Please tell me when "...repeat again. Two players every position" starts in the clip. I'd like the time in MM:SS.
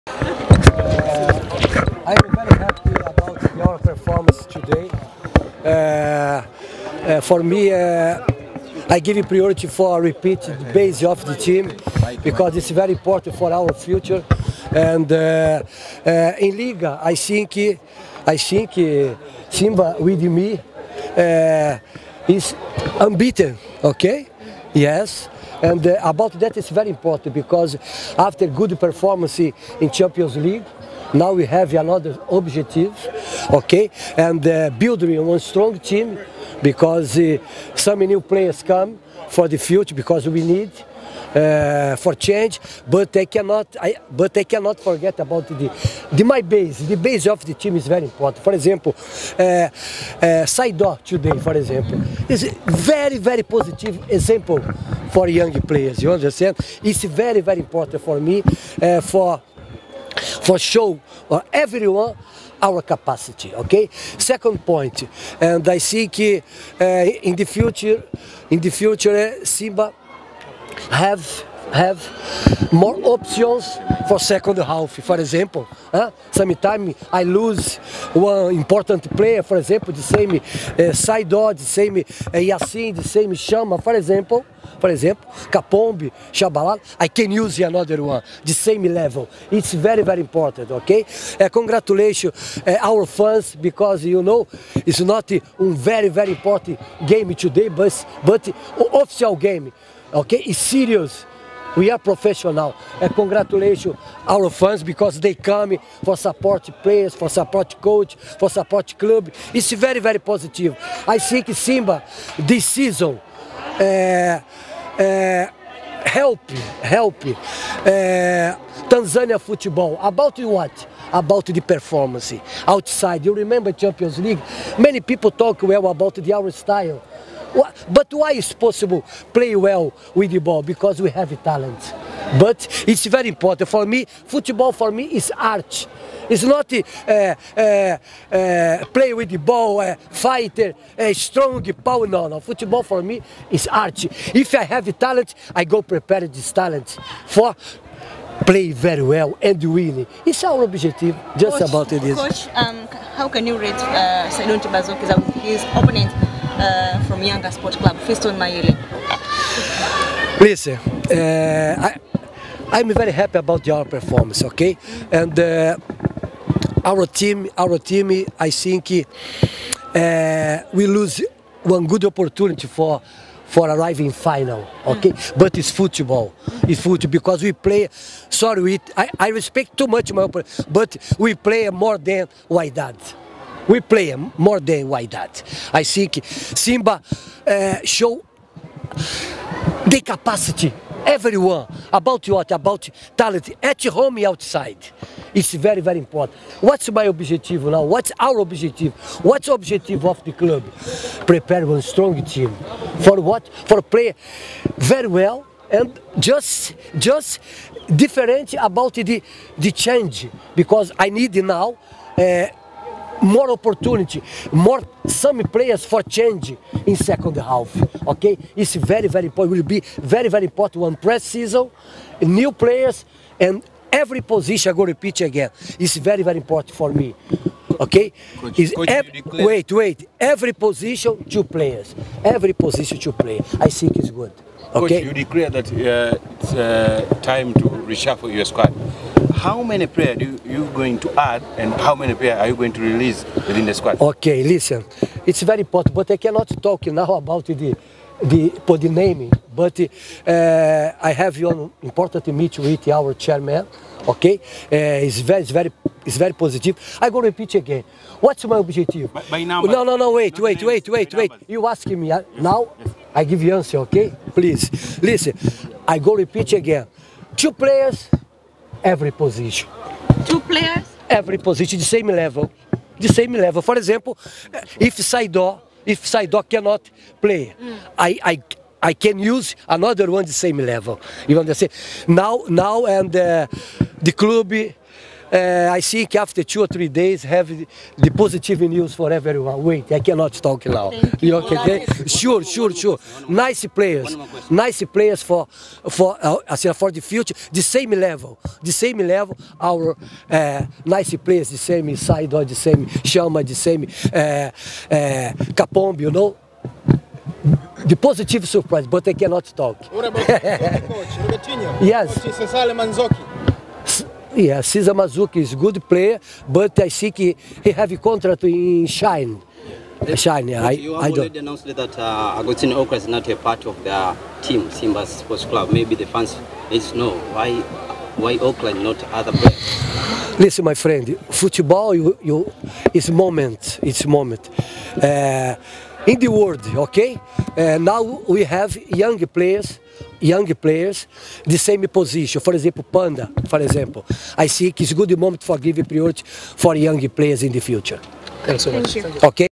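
04:26.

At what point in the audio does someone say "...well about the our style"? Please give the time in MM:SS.
02:05.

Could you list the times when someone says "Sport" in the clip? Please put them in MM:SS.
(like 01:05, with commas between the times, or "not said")
02:37, 05:25.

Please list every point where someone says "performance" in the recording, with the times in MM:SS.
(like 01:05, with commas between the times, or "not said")
00:03, 00:28, 02:01, 02:43.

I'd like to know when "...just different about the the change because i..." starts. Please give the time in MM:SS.
03:26.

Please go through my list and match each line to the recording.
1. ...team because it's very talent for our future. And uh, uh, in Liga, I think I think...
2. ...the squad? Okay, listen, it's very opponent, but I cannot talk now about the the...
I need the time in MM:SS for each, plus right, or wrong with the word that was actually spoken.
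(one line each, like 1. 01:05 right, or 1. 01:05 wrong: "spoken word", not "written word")
1. 00:11 wrong: "important", not "talent"
2. 04:03 wrong: "important", not "opponent".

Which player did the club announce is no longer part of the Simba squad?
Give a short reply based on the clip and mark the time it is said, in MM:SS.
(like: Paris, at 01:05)
Augustine Okrah, at 05:22.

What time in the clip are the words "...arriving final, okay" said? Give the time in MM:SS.
02:53.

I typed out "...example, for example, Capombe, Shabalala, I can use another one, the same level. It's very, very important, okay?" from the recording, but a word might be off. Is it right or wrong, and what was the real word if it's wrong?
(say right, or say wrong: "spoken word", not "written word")
right.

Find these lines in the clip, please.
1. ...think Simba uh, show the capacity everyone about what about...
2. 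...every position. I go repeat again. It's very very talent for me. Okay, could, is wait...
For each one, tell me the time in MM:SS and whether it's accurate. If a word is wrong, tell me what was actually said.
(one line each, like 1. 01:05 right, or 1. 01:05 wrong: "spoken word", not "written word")
1. 03:05 right
2. 03:43 wrong: "important", not "talent".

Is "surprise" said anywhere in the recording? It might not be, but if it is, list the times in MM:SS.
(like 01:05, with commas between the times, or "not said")
05:08.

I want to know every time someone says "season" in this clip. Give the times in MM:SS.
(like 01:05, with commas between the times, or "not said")
01:52, 03:41.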